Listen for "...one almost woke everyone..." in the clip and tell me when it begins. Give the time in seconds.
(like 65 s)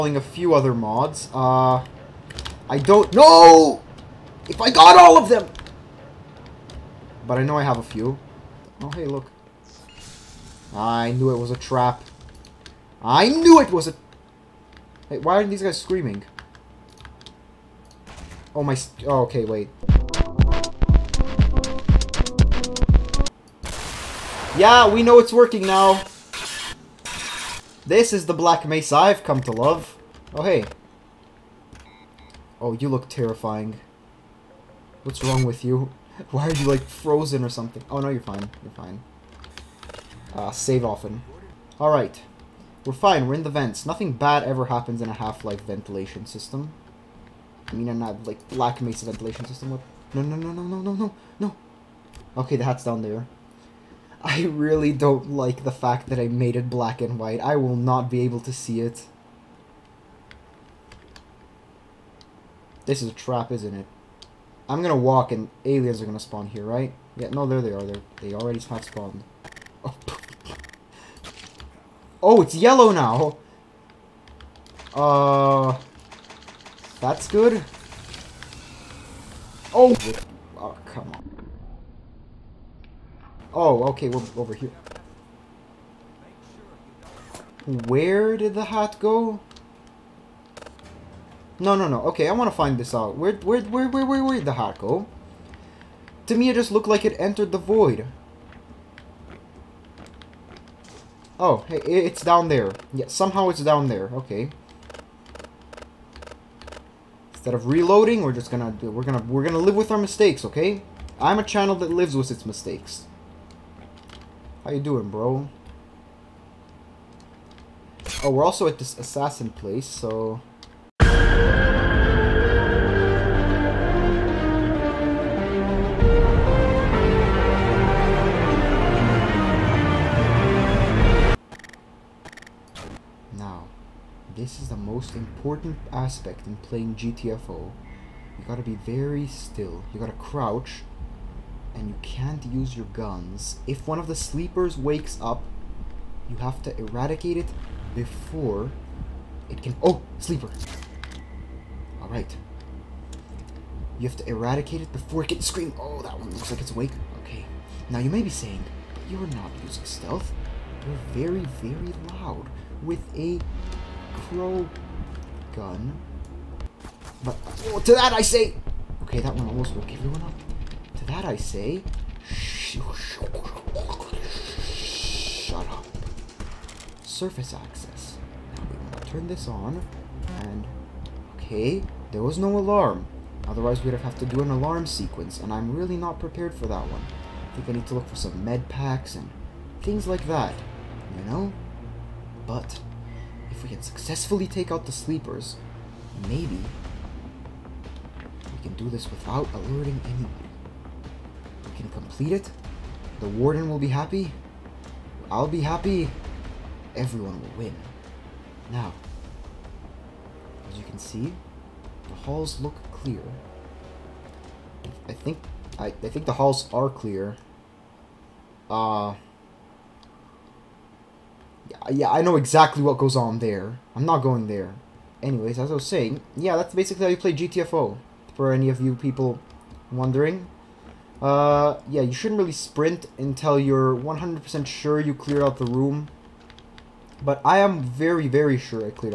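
169 s.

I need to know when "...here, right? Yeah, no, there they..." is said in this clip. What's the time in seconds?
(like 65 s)
66 s.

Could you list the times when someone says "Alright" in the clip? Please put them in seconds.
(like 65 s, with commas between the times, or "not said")
41 s, 152 s.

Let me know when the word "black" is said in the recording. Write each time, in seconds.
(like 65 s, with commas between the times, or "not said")
28 s, 56 s.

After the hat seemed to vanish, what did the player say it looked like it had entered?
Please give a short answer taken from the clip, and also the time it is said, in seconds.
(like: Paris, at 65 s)
the void, at 97 s.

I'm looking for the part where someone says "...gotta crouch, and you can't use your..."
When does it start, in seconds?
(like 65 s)
139 s.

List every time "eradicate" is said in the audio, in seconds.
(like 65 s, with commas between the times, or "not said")
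146 s, 154 s.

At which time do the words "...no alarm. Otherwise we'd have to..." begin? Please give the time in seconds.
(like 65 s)
182 s.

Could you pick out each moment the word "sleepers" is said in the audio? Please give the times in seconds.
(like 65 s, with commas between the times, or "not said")
144 s, 150 s, 194 s.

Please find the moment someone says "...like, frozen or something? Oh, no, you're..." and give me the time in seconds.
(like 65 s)
36 s.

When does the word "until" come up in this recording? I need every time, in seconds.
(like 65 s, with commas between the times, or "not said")
233 s.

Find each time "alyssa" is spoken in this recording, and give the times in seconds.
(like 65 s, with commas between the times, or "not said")
not said.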